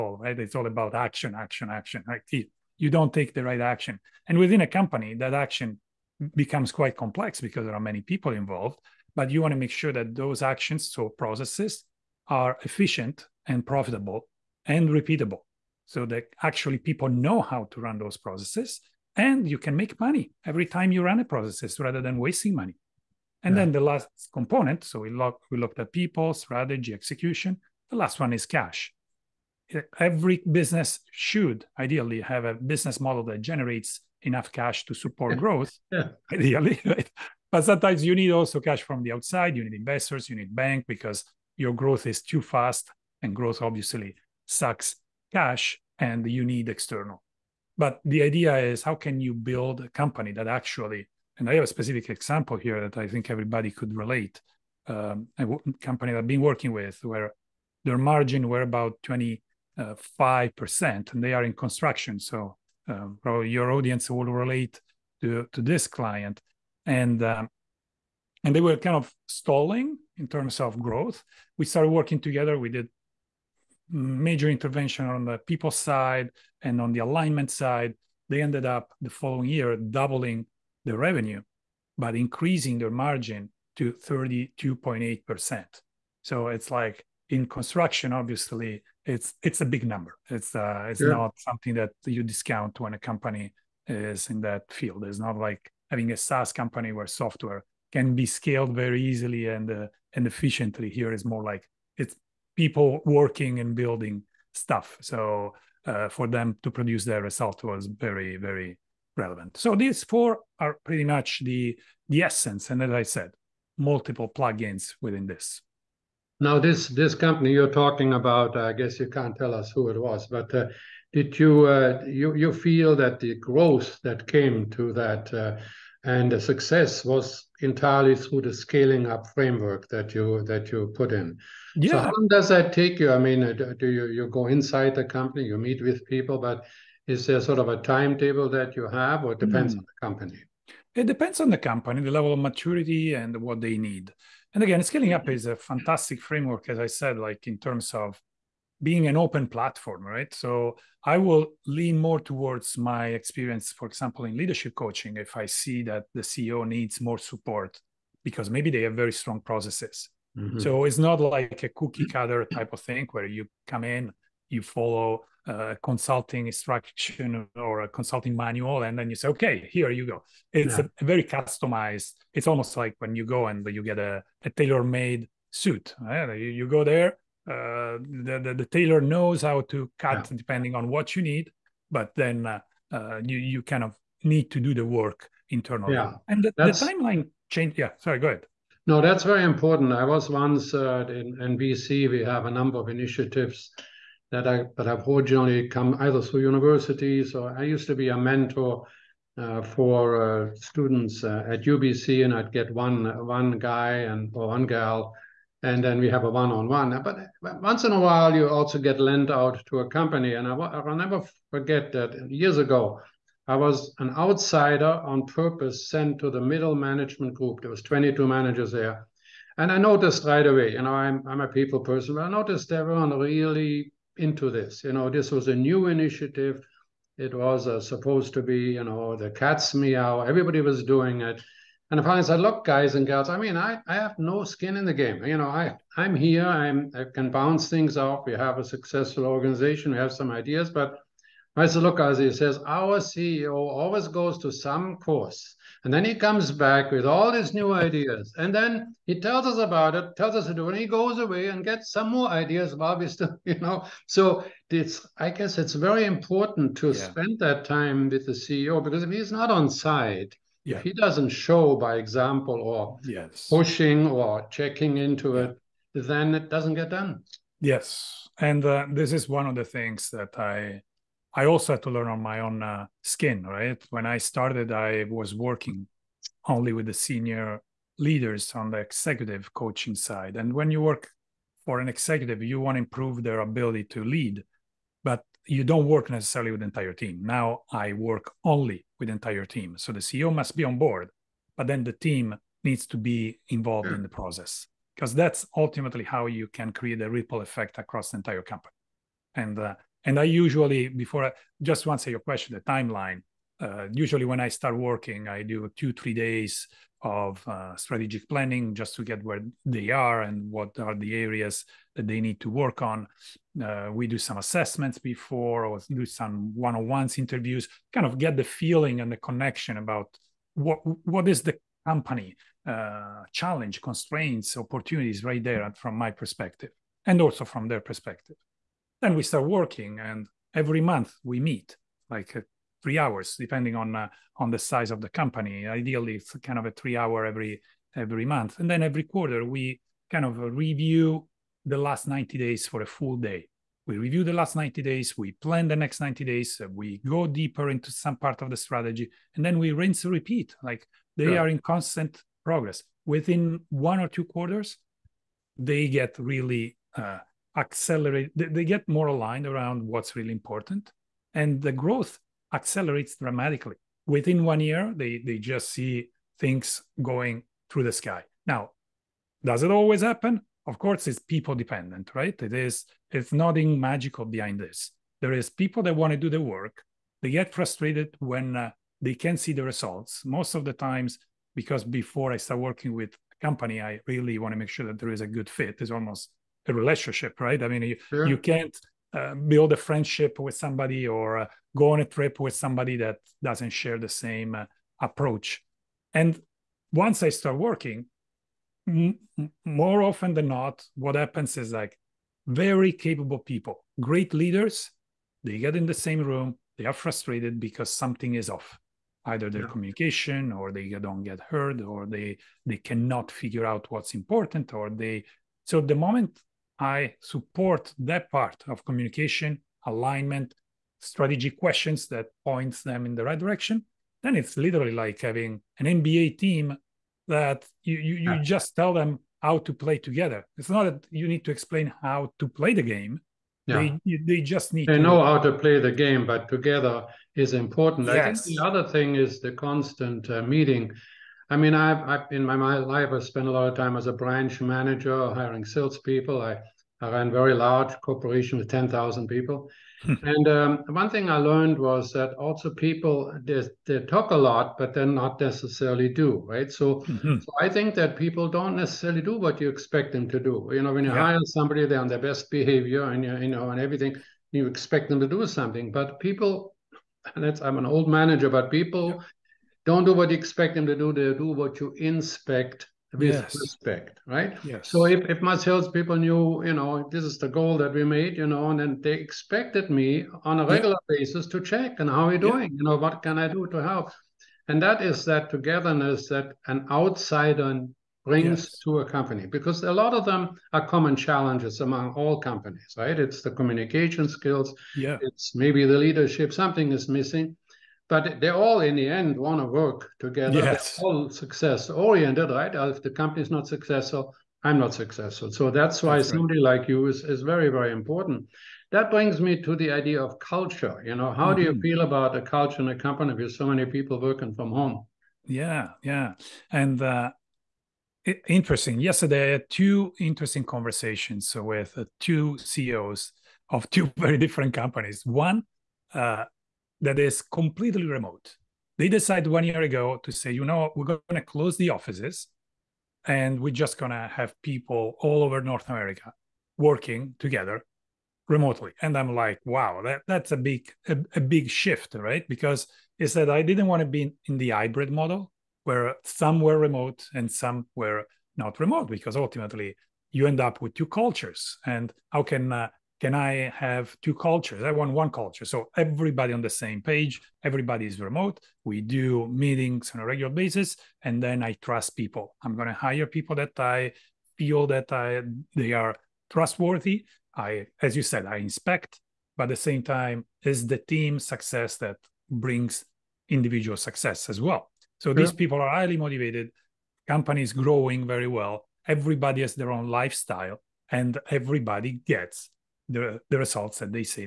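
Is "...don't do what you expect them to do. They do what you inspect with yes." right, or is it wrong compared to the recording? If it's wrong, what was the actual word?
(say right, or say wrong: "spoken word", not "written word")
right.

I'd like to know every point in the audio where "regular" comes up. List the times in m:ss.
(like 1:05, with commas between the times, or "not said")
8:00, 9:20.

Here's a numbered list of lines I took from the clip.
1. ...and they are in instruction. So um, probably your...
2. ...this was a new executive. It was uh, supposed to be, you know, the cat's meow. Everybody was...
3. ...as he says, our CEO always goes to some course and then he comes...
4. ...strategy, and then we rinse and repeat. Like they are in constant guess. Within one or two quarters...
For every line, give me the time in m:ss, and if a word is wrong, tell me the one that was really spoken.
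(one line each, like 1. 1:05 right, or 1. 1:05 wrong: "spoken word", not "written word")
1. 1:01 wrong: "construction", not "instruction"
2. 3:45 wrong: "initiative", not "executive"
3. 4:02 right
4. 5:48 wrong: "progress", not "guess".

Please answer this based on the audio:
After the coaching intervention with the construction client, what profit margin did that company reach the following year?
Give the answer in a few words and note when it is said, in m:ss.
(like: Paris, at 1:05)
32.8%, at 1:23.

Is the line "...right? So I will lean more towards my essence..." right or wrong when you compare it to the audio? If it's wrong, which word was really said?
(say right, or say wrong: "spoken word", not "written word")
wrong: "experience", not "essence".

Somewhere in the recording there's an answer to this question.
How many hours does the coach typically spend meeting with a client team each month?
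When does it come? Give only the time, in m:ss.
5:32.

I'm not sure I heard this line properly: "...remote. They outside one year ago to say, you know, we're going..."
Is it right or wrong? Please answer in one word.
wrong.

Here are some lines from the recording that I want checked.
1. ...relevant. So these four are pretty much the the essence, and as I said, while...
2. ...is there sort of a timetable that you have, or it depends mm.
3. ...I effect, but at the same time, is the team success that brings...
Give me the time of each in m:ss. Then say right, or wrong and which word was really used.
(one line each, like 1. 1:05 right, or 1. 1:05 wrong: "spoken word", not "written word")
1. 1:49 wrong: "multiple", not "while"
2. 2:17 right
3. 9:28 wrong: "inspect", not "effect".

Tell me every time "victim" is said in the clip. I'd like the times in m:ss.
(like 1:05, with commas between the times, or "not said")
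not said.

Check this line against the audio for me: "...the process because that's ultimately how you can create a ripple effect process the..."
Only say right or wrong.
wrong.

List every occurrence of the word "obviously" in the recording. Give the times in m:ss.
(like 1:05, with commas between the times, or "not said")
0:43, 1:28.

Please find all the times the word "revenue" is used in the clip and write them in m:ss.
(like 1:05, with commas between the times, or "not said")
1:20.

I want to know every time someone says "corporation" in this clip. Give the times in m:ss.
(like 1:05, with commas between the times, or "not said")
7:28.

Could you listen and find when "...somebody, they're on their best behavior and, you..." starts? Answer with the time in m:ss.
7:41.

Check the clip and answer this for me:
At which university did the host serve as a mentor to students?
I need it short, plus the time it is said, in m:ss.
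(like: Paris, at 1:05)
UBC, at 3:21.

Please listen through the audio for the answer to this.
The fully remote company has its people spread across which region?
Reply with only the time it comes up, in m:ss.
8:55.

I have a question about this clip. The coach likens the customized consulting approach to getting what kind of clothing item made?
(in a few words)
tailor-made suit.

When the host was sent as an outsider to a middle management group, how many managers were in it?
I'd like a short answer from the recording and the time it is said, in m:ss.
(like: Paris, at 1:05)
22, at 3:37.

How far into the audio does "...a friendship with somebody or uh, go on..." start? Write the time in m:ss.
6:29.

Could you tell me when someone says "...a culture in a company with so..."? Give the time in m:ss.
8:32.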